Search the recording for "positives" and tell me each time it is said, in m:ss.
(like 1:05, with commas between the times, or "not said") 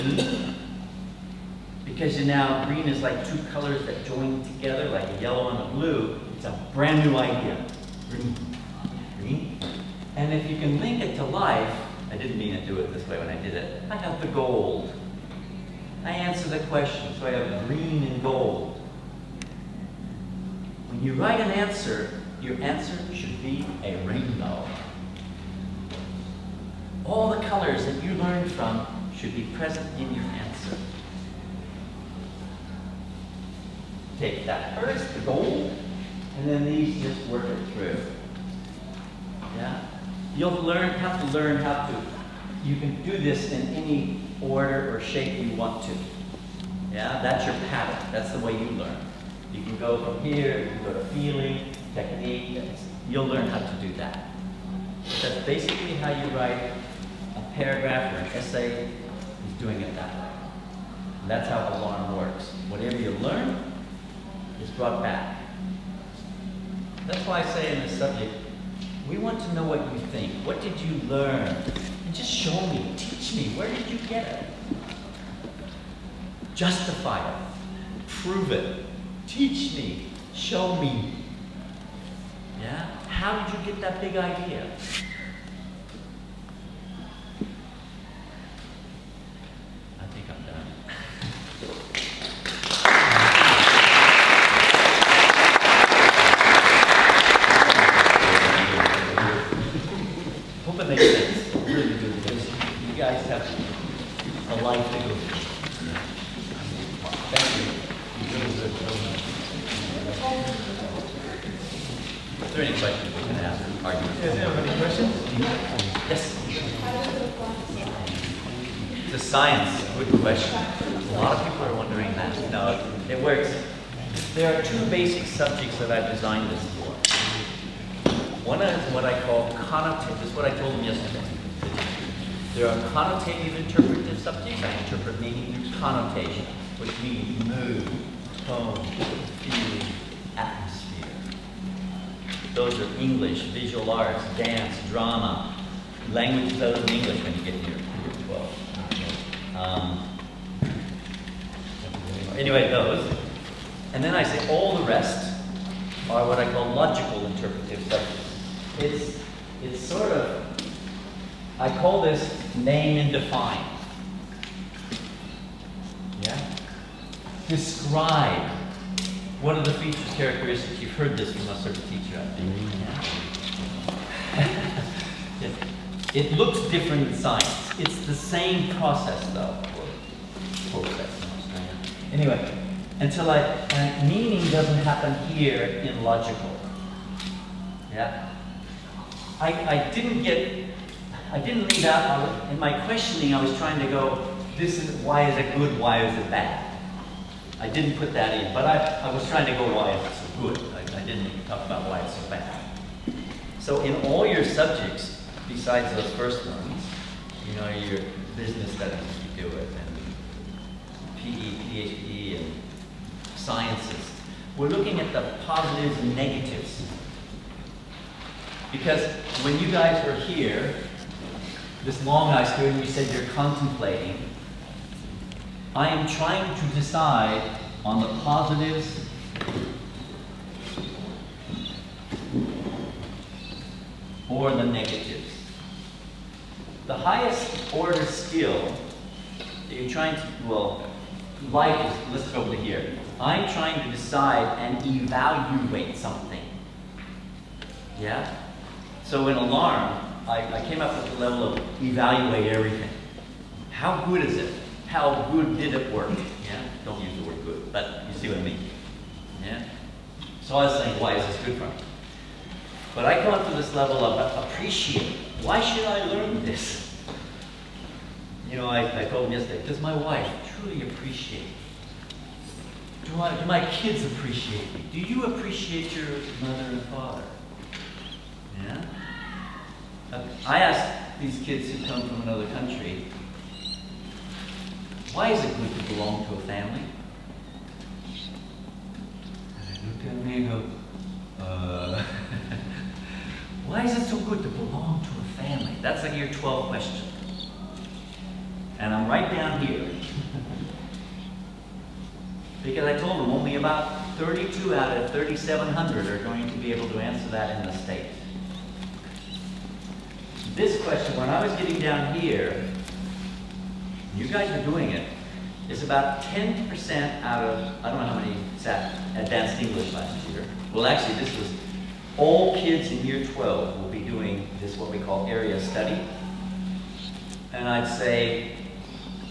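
3:35, 3:48.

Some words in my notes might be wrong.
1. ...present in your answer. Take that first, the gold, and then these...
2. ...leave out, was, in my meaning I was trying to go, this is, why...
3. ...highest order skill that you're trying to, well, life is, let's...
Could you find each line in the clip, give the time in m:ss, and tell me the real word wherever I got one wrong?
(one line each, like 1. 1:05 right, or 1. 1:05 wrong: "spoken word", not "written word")
1. 0:29 right
2. 3:11 wrong: "questioning", not "meaning"
3. 3:56 right.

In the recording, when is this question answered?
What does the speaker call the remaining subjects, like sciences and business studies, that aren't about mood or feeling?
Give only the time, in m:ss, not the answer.
2:36.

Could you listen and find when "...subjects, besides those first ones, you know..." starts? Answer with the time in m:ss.
3:24.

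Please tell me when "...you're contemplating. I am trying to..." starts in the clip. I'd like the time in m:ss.
3:43.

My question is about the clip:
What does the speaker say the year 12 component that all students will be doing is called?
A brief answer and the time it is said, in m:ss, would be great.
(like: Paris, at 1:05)
Area study, at 5:25.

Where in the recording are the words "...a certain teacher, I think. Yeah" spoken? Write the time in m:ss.
2:51.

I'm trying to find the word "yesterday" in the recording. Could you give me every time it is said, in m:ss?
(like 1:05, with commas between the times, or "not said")
2:10, 4:29.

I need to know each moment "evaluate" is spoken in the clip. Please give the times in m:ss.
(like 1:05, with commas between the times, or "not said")
4:04, 4:11.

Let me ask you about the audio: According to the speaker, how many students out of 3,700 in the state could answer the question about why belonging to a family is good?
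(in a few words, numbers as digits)
32.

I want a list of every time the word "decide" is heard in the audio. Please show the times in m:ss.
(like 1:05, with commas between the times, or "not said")
3:46, 4:03.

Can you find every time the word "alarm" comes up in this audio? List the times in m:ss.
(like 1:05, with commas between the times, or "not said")
1:01, 4:09.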